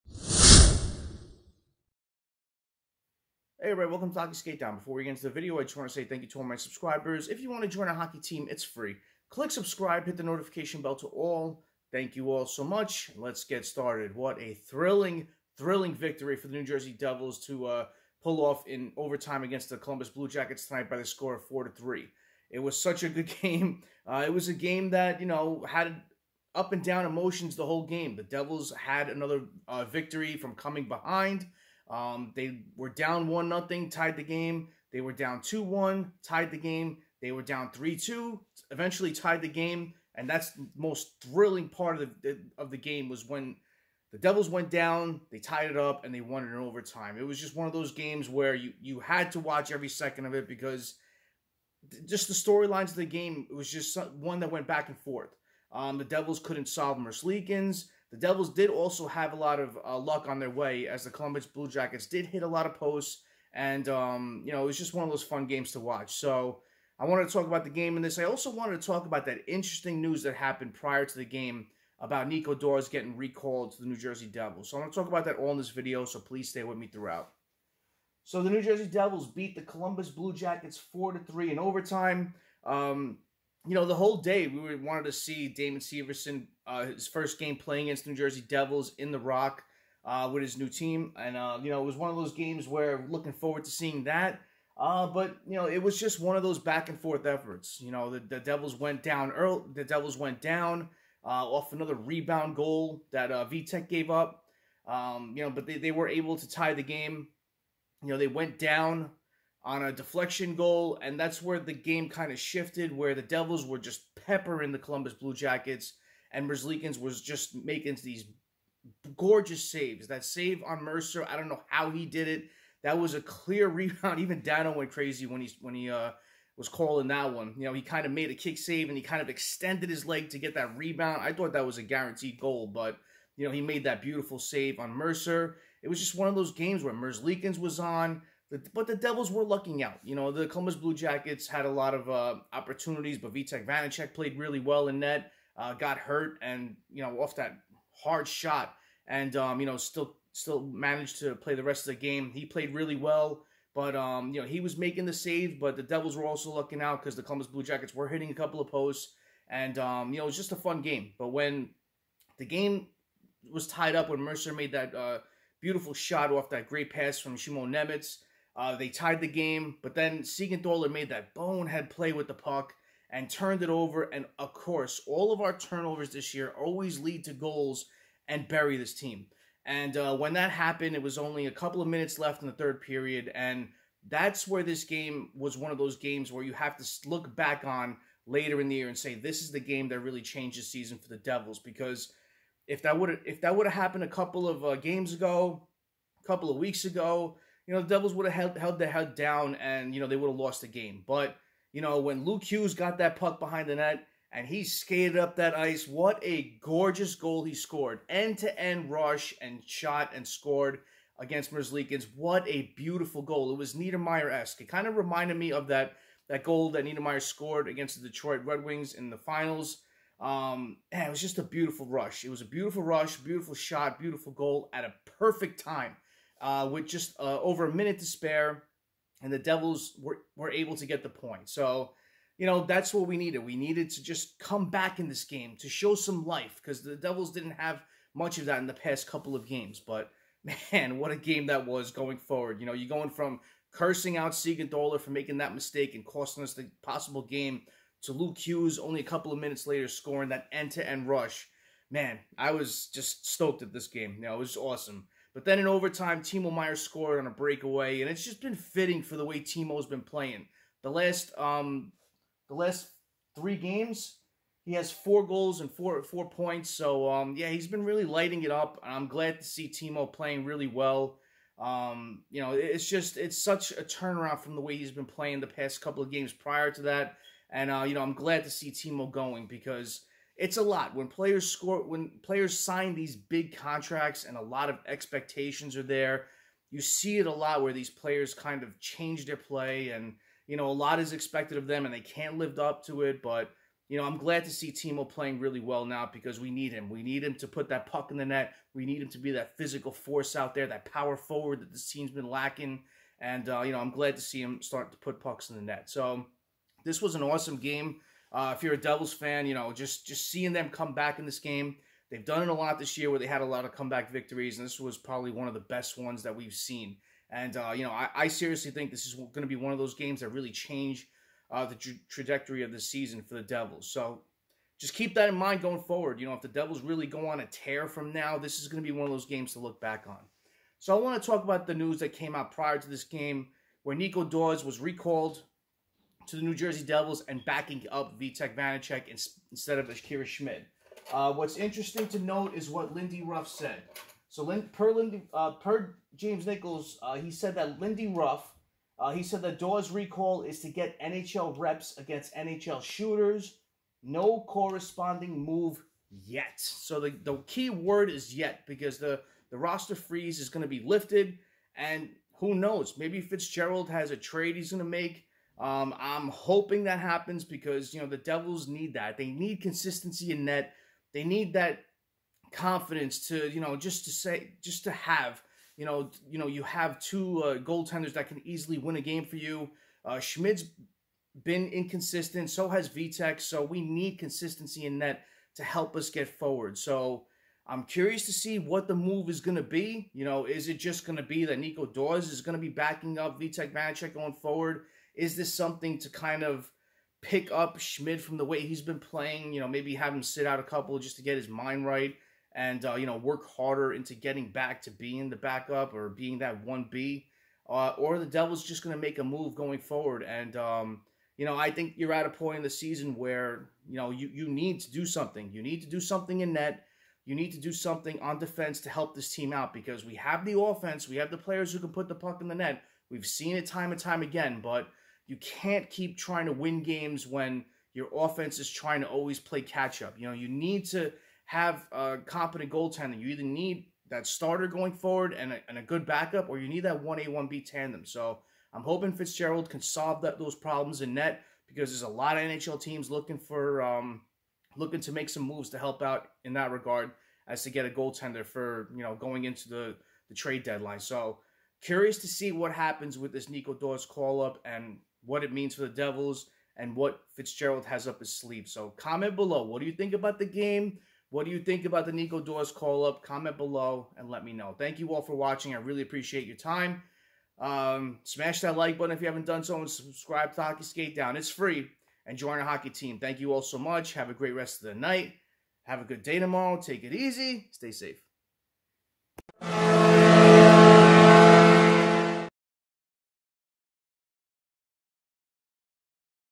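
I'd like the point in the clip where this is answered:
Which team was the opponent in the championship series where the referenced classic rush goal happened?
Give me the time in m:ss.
3:38.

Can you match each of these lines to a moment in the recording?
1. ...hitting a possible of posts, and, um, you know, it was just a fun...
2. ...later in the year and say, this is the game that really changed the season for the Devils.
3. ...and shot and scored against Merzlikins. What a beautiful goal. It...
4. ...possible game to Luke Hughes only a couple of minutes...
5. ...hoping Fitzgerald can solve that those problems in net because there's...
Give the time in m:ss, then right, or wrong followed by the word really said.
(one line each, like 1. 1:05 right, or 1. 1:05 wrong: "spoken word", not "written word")
1. 2:38 wrong: "couple", not "possible"
2. 3:08 right
3. 3:29 right
4. 4:06 right
5. 7:18 right.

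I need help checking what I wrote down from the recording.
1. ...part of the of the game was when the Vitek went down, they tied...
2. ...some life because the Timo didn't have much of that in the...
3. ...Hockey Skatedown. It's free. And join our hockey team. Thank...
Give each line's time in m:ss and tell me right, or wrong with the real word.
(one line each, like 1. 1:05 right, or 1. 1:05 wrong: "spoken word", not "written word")
1. 0:41 wrong: "Devils", not "Vitek"
2. 3:55 wrong: "Devils", not "Timo"
3. 7:50 right.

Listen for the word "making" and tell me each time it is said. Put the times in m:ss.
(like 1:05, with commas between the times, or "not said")
1:57, 2:34, 4:05.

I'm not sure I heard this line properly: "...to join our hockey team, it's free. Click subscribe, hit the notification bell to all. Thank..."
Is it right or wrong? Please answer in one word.
right.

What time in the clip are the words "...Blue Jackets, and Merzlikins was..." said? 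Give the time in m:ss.
1:55.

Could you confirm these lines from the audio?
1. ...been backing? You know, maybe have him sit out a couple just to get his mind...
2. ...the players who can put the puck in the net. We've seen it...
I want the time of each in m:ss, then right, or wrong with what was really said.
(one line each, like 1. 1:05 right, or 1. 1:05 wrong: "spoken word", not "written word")
1. 6:38 wrong: "playing", not "backing"
2. 7:01 right.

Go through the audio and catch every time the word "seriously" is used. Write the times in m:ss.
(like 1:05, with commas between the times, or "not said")
5:18.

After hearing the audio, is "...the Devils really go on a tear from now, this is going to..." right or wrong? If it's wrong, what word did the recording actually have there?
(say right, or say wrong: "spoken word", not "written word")
right.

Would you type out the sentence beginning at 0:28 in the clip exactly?
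The Devils had another uh, victory from coming behind – um, they were down one nothing, tied the game.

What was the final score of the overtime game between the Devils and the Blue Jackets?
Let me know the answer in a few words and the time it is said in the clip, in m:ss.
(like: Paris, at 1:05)
4-3, at 0:21.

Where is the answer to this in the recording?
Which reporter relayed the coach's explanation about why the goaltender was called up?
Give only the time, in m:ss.
5:46.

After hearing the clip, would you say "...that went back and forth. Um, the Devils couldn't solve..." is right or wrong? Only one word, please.
right.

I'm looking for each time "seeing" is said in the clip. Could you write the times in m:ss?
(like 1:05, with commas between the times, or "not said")
1:33, 5:10.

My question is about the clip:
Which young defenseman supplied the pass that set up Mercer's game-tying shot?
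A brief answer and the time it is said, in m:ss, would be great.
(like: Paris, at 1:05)
Simon Nemec, at 2:47.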